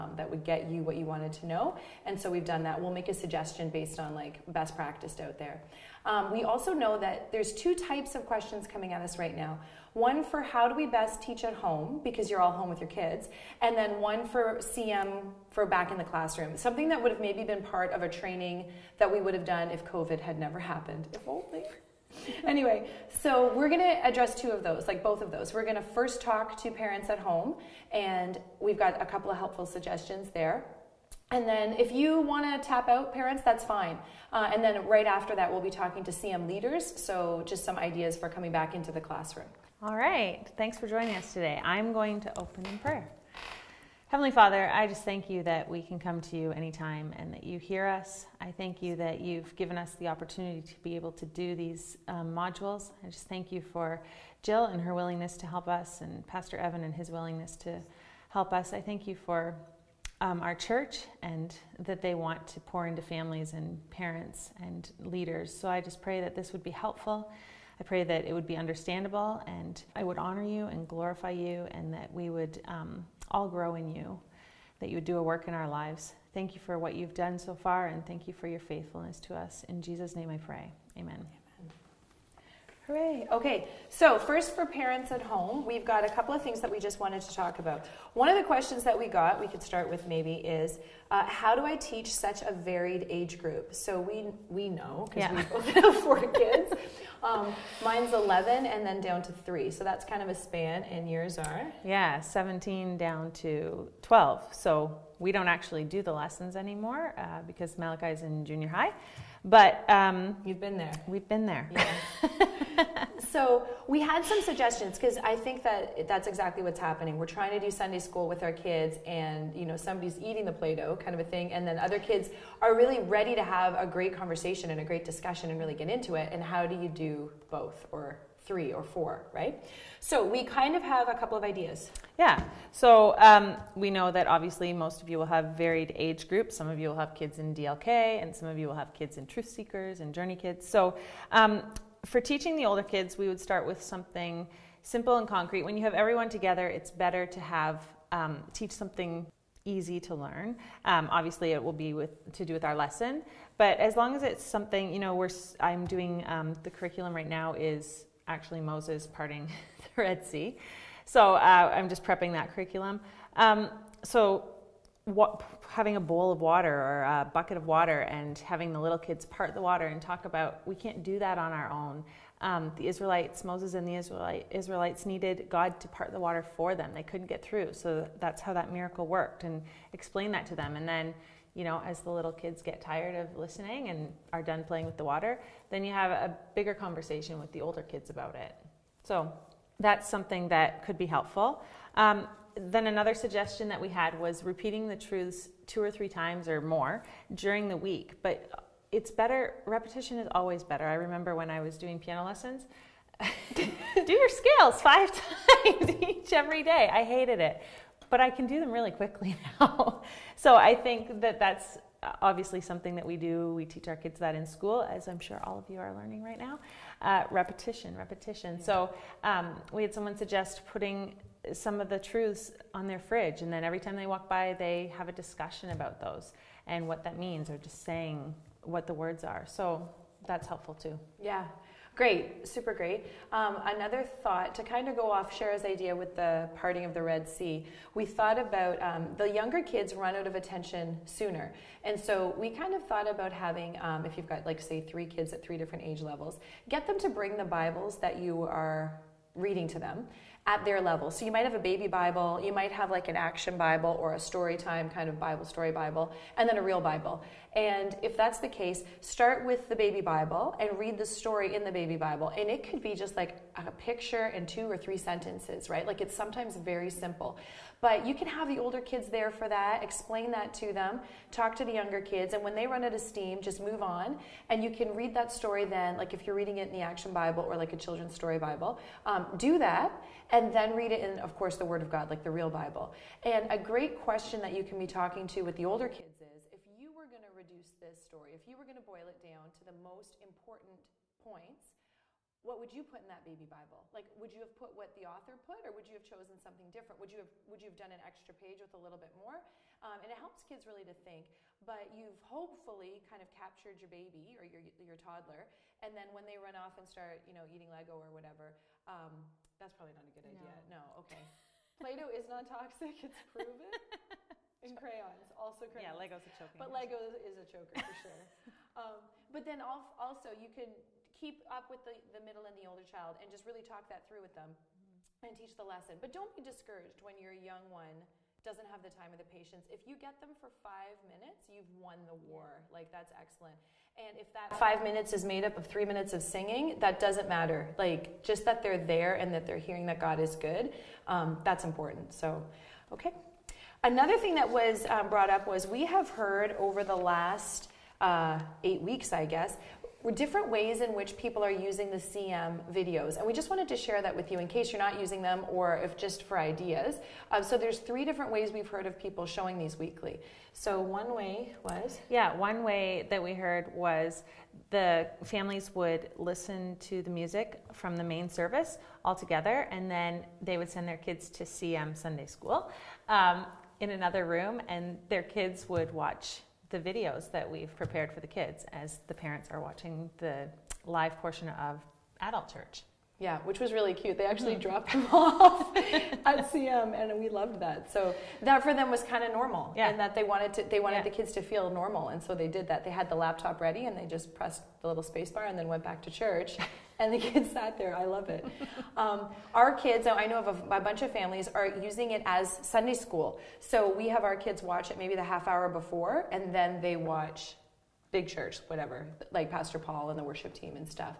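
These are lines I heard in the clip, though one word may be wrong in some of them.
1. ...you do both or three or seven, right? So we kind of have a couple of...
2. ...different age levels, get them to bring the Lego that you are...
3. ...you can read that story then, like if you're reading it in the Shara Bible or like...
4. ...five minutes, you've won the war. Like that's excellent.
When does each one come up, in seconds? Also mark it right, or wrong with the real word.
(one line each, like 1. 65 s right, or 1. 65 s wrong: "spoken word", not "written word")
1. 126 s wrong: "four", not "seven"
2. 245 s wrong: "Bibles", not "Lego"
3. 274 s wrong: "Action", not "Shara"
4. 330 s right.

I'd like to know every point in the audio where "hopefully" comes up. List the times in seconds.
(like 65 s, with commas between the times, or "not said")
302 s.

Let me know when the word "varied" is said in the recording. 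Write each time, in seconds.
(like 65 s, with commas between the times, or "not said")
92 s, 135 s.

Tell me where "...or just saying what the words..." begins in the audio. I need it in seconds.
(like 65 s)
227 s.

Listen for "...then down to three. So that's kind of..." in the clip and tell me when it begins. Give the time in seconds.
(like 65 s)
98 s.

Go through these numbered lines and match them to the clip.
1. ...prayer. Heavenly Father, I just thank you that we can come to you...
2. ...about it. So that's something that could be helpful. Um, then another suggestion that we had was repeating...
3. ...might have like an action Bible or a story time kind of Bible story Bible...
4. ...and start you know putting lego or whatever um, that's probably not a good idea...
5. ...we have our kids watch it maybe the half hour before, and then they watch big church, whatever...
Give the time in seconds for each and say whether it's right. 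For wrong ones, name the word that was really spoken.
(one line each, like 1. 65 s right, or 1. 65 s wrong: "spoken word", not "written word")
1. 42 s right
2. 188 s right
3. 252 s right
4. 306 s wrong: "eating", not "putting"
5. 403 s right.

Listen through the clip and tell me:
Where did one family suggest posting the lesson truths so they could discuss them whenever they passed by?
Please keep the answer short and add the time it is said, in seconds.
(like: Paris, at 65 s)
On their fridge, at 222 s.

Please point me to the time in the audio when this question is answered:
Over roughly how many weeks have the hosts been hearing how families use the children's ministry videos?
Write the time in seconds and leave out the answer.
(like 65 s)
348 s.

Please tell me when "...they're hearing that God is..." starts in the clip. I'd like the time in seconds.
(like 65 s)
339 s.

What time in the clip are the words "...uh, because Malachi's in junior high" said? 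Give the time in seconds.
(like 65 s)
107 s.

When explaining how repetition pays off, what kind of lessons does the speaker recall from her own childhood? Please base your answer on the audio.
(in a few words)
Piano lessons.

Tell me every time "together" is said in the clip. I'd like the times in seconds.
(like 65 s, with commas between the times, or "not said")
146 s, 369 s.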